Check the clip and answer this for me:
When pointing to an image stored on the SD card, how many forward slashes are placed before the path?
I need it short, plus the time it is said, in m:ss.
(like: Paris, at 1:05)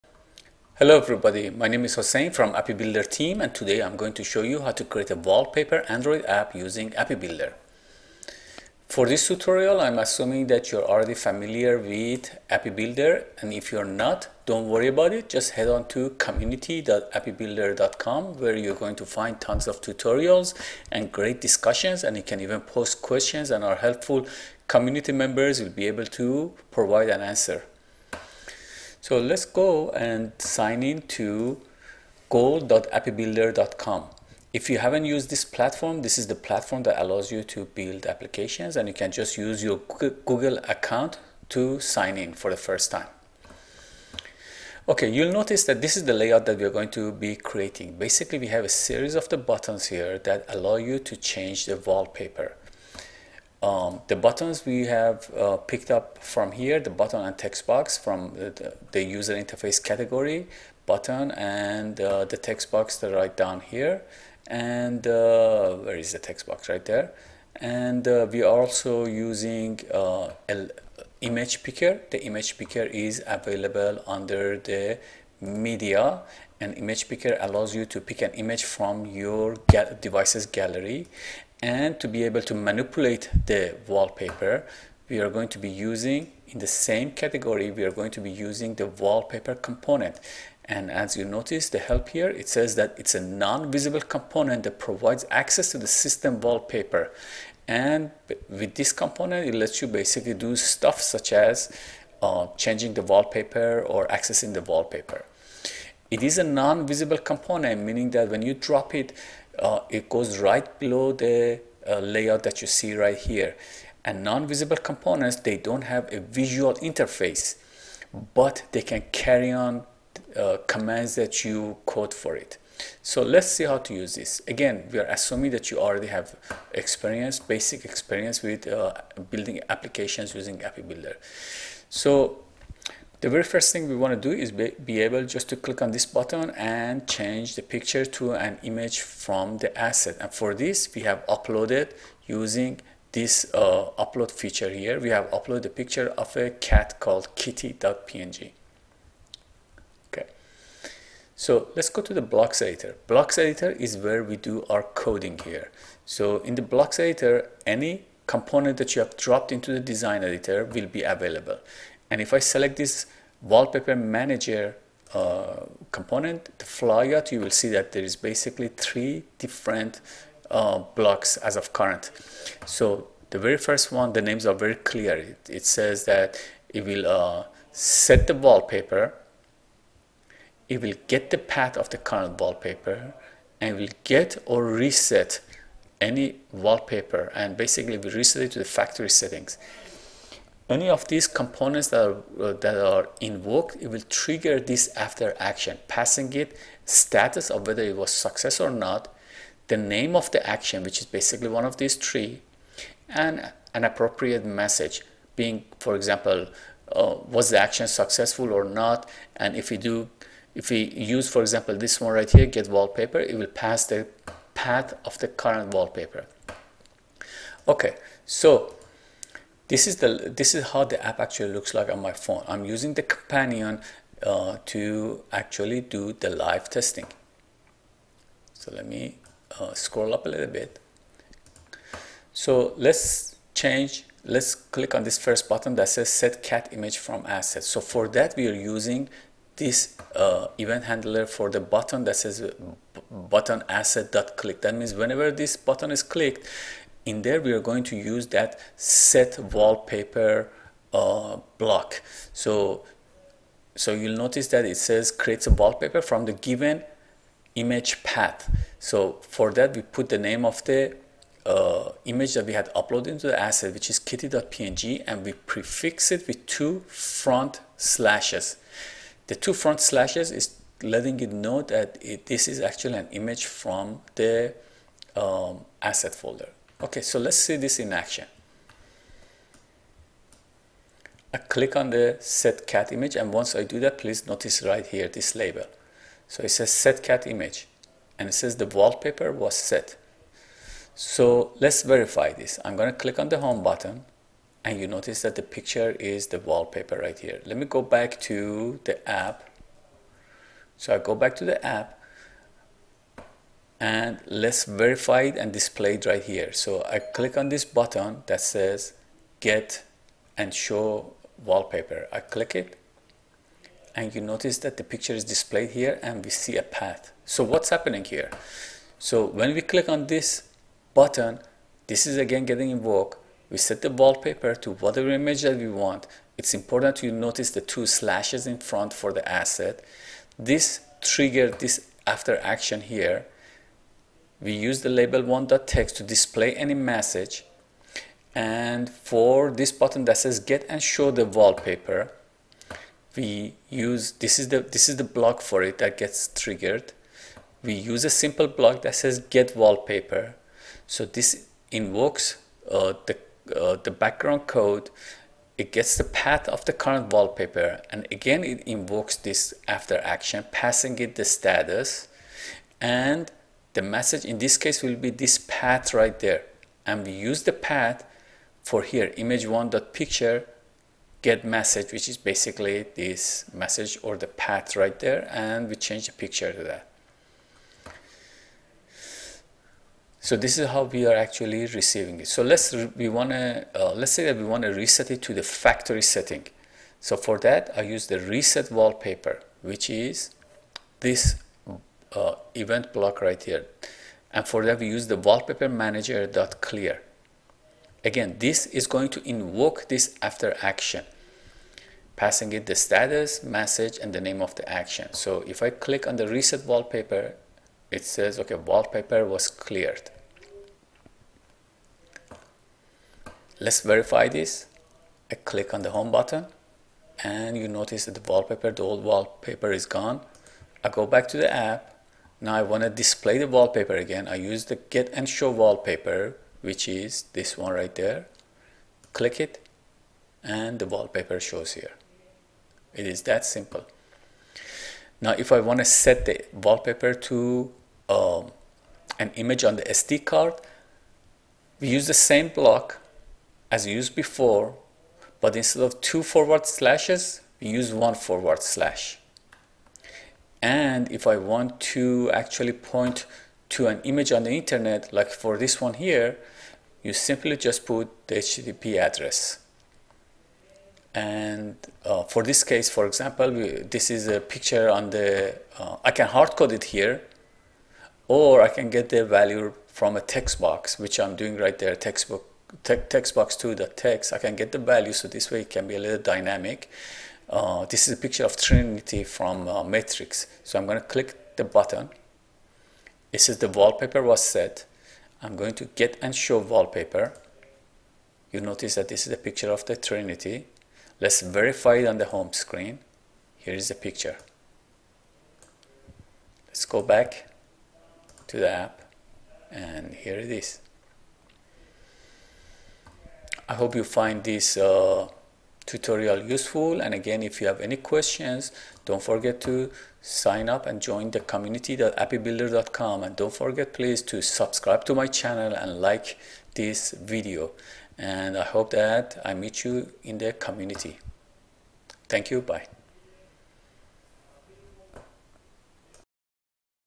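1, at 7:27.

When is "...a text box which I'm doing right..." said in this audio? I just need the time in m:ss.
7:50.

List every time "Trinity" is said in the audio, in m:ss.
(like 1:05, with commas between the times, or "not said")
7:58, 8:09.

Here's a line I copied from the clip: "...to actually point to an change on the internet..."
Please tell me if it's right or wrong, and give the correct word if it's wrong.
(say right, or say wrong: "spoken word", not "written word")
wrong: "image", not "change".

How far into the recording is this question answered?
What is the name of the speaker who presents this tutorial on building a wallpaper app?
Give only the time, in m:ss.
0:01.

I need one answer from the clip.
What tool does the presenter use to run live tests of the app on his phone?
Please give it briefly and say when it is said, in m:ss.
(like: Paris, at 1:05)
the companion, at 3:43.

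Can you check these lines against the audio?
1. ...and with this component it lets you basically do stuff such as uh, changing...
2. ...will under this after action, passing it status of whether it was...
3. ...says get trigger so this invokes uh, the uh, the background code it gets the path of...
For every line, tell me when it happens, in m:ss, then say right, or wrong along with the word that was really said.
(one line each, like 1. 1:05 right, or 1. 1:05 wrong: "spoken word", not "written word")
1. 1:37 right
2. 3:13 wrong: "trigger", not "under"
3. 5:48 wrong: "wallpaper", not "trigger".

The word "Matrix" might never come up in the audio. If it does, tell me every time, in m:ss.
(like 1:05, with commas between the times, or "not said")
7:59.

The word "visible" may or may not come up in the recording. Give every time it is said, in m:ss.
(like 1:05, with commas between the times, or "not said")
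1:33, 1:46, 1:54.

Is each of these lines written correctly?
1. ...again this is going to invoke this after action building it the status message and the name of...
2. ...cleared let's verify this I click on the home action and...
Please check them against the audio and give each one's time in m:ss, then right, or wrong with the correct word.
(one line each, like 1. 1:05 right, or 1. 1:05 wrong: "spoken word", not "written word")
1. 6:38 wrong: "passing", not "building"
2. 6:49 wrong: "button", not "action".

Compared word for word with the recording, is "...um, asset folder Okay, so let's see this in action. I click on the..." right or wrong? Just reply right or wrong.
right.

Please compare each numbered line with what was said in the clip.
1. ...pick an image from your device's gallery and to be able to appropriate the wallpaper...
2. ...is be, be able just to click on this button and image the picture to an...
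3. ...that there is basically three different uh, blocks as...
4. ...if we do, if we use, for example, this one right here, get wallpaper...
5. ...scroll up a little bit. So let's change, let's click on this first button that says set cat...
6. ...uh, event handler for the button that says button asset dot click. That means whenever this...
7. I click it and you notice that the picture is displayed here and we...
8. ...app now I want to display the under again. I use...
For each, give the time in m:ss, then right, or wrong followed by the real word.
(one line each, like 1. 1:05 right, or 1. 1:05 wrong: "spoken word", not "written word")
1. 1:17 wrong: "manipulate", not "appropriate"
2. 2:14 wrong: "change", not "image"
3. 2:47 right
4. 3:29 right
5. 3:49 right
6. 4:00 right
7. 5:12 right
8. 7:01 wrong: "wallpaper", not "under".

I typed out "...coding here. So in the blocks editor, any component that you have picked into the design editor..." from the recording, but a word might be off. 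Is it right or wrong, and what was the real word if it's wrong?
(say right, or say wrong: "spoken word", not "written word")
wrong: "dropped", not "picked".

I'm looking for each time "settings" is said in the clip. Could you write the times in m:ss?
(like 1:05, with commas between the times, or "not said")
3:09, 6:26.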